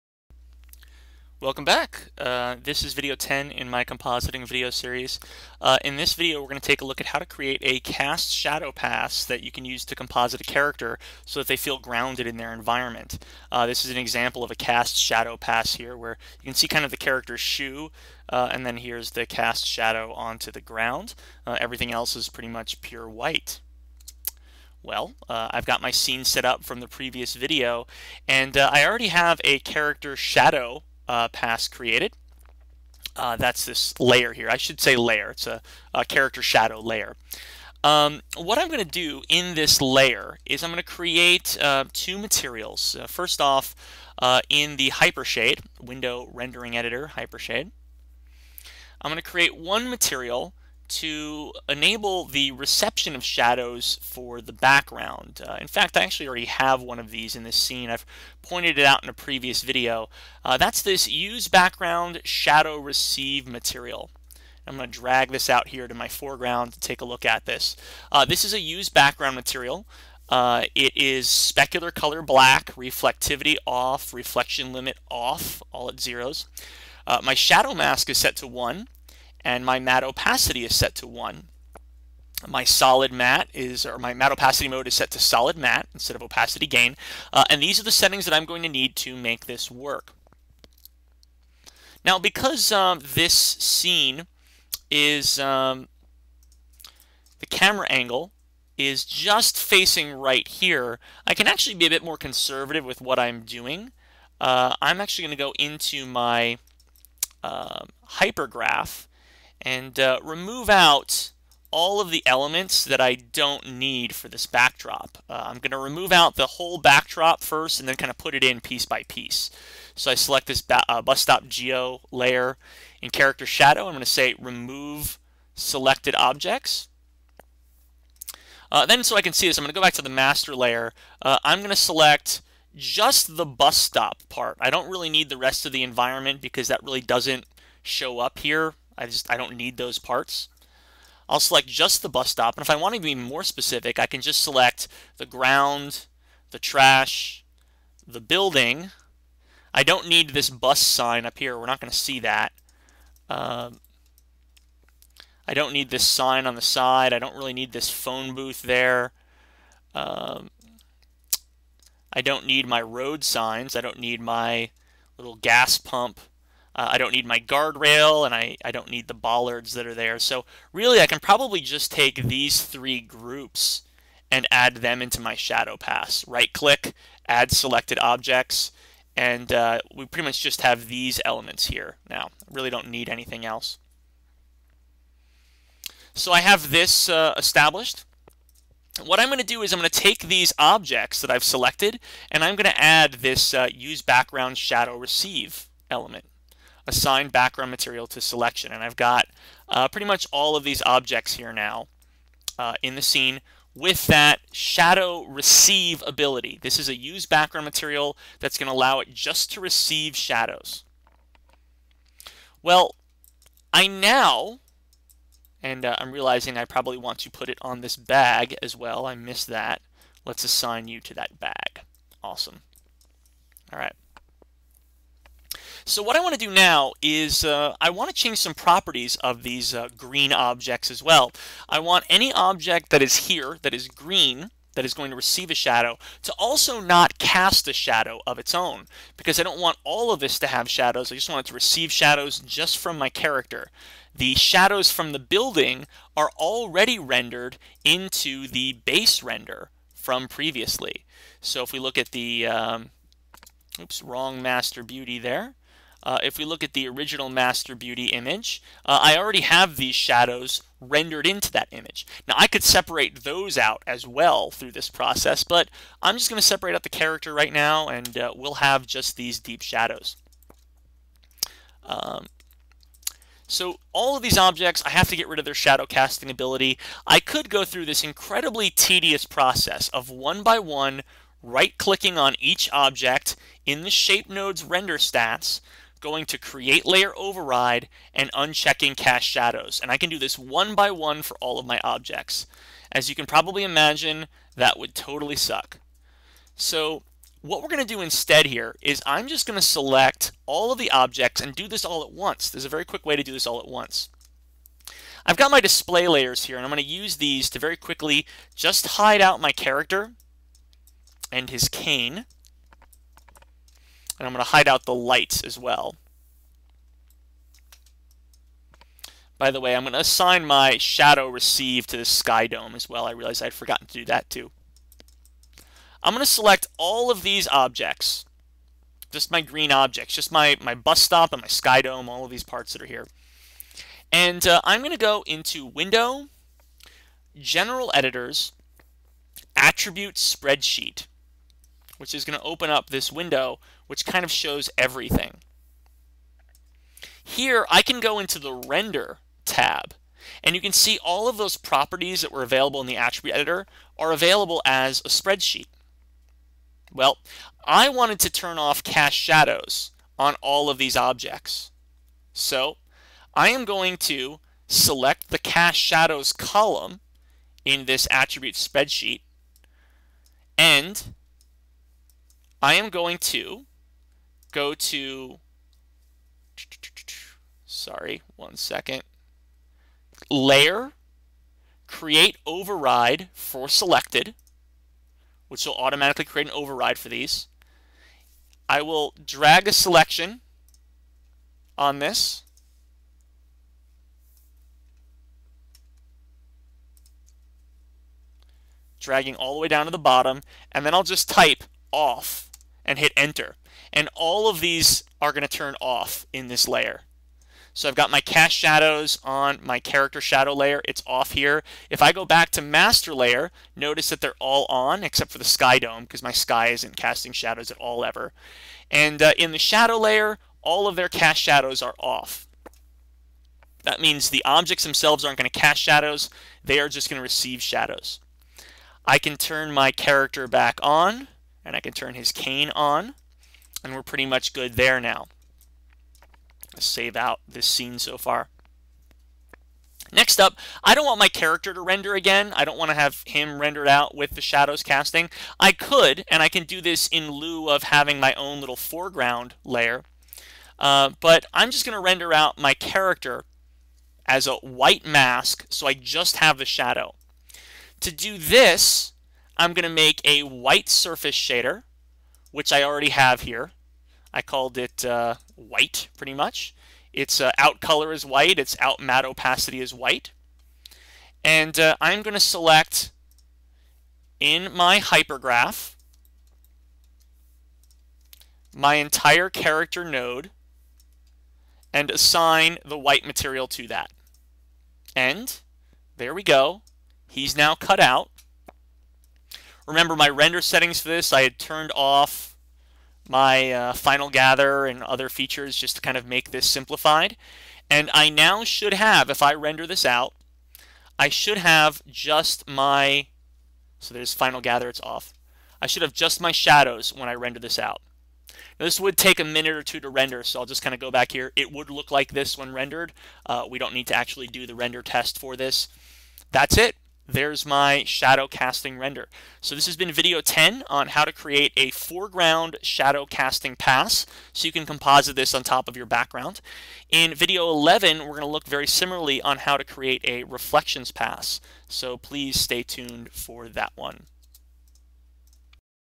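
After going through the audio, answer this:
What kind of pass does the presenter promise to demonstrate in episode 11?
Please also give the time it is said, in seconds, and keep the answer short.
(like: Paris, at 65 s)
reflections pass, at 530 s.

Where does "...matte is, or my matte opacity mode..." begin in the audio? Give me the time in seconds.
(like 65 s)
83 s.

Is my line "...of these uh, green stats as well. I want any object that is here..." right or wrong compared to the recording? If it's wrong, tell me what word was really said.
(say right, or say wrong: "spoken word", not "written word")
wrong: "objects", not "stats".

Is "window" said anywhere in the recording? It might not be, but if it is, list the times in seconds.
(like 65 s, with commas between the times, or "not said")
45 s, 335 s, 343 s.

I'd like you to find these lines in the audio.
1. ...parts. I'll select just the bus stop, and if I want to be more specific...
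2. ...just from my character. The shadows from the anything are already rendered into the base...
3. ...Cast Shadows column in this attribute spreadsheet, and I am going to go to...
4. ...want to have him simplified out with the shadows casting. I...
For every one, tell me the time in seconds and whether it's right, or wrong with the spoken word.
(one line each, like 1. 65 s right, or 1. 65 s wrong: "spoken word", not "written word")
1. 139 s right
2. 242 s wrong: "building", not "anything"
3. 365 s right
4. 442 s wrong: "rendered", not "simplified".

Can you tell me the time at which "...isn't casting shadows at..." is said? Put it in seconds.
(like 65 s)
416 s.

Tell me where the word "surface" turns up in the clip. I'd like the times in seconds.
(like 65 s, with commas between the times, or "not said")
460 s.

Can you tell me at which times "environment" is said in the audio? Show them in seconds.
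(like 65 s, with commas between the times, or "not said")
12 s, 135 s.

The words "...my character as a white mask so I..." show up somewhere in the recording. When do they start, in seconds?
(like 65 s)
452 s.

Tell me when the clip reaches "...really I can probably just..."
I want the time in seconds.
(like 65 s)
170 s.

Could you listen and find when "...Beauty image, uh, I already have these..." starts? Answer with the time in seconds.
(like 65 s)
257 s.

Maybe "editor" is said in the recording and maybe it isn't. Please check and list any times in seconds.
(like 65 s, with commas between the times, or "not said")
46 s, 337 s, 353 s.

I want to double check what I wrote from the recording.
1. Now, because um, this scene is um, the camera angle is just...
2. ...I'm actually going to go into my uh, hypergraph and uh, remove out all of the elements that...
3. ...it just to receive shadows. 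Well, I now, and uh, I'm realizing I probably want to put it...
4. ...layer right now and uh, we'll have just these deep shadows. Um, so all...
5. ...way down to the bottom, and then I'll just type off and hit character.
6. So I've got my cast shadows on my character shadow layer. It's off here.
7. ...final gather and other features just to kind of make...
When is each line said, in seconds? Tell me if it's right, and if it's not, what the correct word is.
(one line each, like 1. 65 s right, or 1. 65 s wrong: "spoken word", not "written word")
1. 92 s right
2. 104 s right
3. 208 s right
4. 266 s wrong: "character", not "layer"
5. 399 s wrong: "enter", not "character"
6. 407 s right
7. 493 s right.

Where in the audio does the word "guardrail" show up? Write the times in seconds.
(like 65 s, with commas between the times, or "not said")
167 s.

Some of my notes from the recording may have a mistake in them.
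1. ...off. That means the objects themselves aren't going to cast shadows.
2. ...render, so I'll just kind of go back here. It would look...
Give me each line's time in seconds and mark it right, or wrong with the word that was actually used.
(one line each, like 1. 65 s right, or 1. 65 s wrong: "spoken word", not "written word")
1. 421 s right
2. 510 s right.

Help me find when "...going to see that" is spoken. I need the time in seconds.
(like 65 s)
151 s.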